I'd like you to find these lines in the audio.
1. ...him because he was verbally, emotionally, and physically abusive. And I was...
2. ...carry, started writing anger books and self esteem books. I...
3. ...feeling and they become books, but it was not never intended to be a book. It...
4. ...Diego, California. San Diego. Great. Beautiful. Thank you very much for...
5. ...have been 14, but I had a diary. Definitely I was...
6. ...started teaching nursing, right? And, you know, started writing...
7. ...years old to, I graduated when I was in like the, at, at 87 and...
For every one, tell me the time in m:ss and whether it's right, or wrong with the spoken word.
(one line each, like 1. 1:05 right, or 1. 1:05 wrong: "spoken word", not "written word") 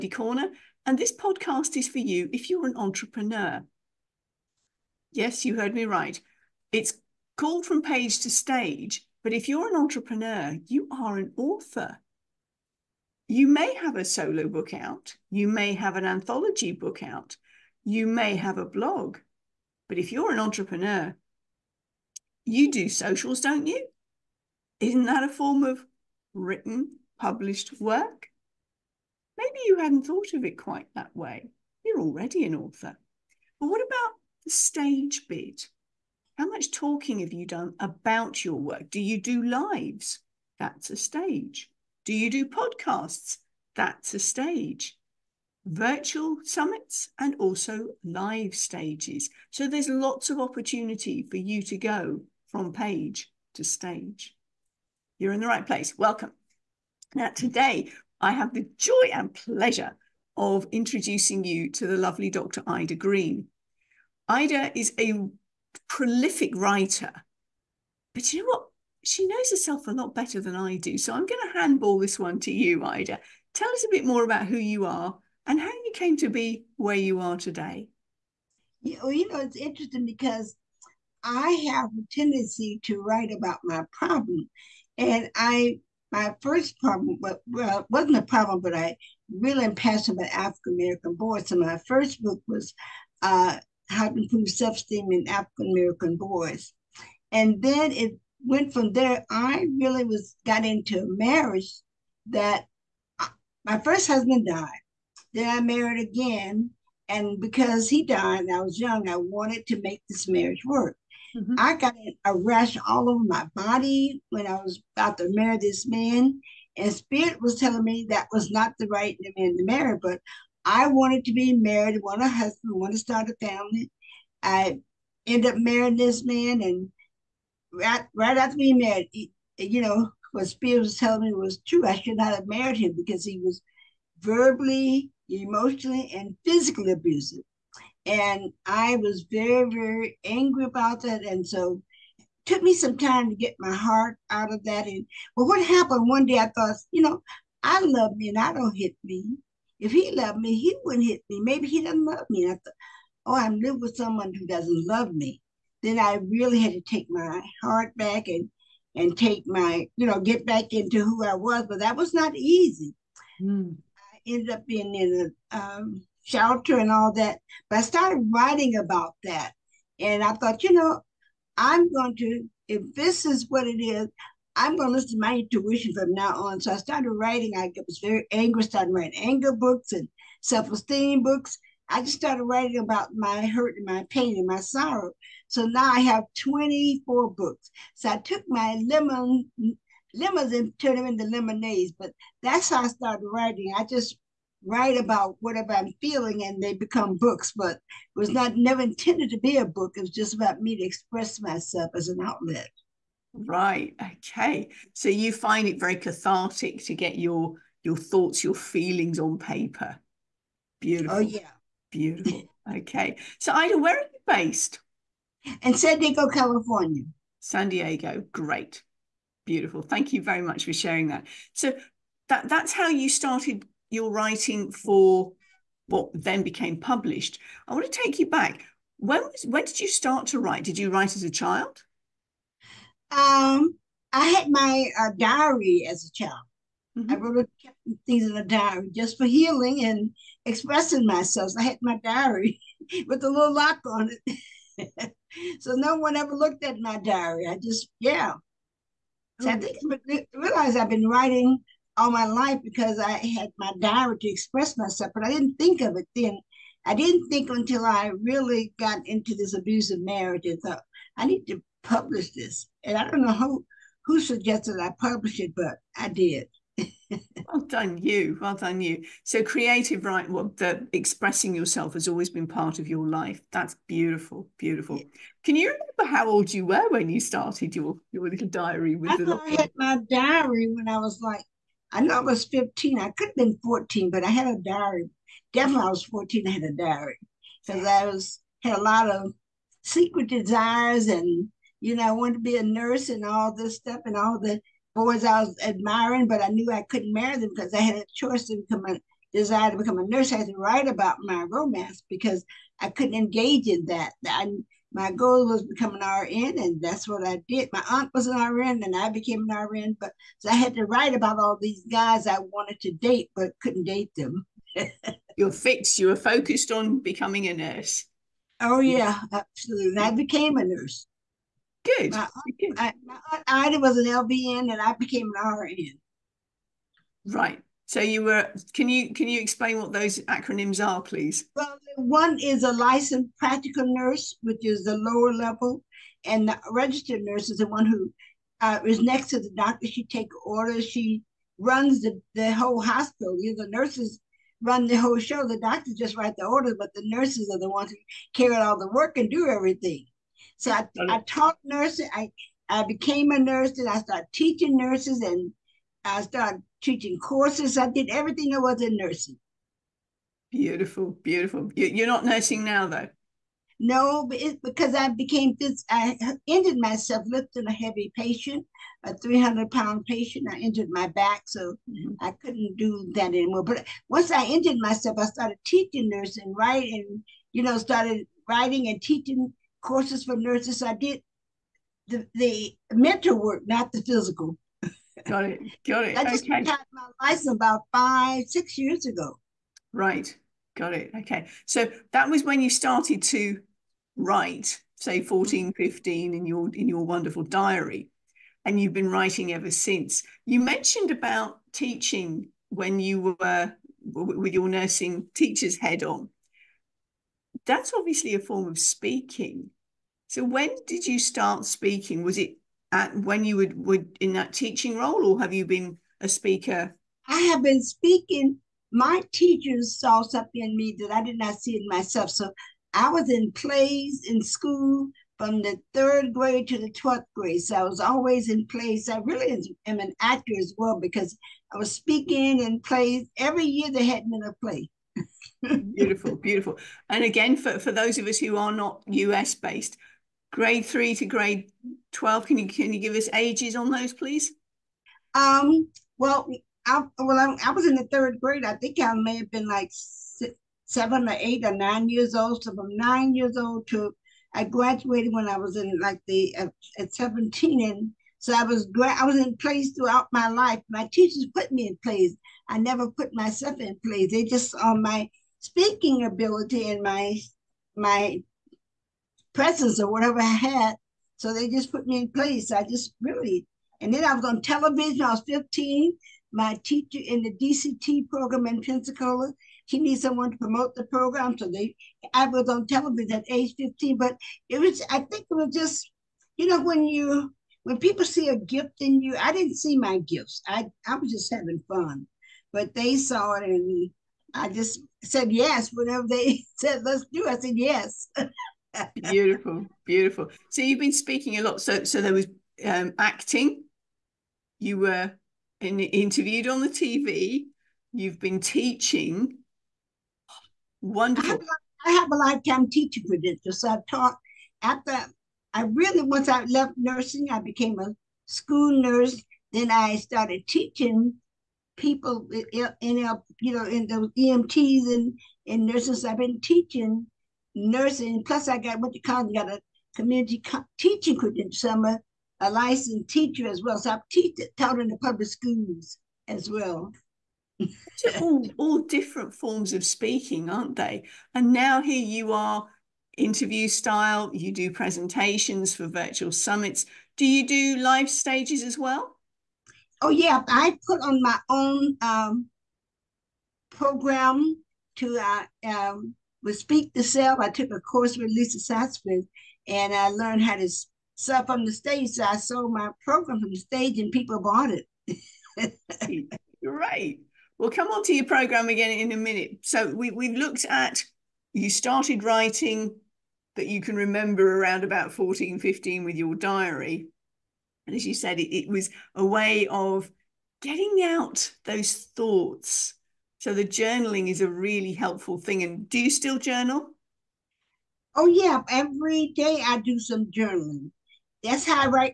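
1. 2:12 right
2. 2:58 wrong: "angry", not "carry"
3. 3:16 right
4. 3:35 right
5. 4:43 right
6. 6:15 right
7. 7:33 wrong: "17", not "87".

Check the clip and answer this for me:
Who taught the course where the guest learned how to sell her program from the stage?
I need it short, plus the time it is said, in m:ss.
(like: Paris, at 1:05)
Lisa Sasevich, at 9:18.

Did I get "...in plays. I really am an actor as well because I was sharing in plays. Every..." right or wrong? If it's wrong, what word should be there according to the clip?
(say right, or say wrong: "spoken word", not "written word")
wrong: "speaking", not "sharing".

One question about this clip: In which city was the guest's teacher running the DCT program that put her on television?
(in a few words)
Pensacola.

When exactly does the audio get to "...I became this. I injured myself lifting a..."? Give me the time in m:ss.
6:04.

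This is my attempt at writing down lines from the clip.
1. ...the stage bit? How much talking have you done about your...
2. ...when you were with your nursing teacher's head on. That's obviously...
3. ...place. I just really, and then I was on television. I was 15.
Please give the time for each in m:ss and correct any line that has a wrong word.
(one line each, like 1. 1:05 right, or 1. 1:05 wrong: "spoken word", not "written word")
1. 0:34 right
2. 6:42 right
3. 7:52 right.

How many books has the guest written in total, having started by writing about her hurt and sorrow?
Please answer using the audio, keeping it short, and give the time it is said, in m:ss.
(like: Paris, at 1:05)
24, at 3:06.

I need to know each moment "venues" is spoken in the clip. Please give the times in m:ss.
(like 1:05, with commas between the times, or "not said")
not said.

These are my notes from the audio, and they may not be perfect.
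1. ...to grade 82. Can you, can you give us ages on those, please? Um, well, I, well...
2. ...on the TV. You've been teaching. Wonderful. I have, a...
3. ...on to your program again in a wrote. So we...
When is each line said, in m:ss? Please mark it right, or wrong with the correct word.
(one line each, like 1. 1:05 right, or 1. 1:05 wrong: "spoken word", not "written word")
1. 7:21 wrong: "12", not "82"
2. 8:26 right
3. 9:28 wrong: "minute", not "wrote".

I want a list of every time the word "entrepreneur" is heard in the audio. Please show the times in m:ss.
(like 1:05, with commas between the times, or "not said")
0:02, 0:09, 0:20.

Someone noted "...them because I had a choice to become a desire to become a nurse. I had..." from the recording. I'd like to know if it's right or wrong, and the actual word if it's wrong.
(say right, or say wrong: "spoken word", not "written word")
right.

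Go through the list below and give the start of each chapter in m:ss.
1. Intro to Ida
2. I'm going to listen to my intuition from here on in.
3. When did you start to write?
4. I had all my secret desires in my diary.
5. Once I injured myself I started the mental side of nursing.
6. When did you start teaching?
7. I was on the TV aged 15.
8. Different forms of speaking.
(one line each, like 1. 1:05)
1. 0:56
2. 2:54
3. 3:46
4. 4:50
5. 6:14
6. 6:51
7. 7:54
8. 8:59.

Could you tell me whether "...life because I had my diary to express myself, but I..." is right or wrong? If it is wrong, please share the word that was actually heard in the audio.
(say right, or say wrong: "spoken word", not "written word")
right.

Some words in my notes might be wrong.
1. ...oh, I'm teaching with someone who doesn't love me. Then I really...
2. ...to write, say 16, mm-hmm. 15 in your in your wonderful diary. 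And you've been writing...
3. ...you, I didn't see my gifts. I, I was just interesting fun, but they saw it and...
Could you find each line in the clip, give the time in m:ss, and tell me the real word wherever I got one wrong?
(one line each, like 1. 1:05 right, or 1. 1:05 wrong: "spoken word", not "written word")
1. 2:33 wrong: "living", not "teaching"
2. 6:33 wrong: "14", not "16"
3. 8:09 wrong: "having", not "interesting".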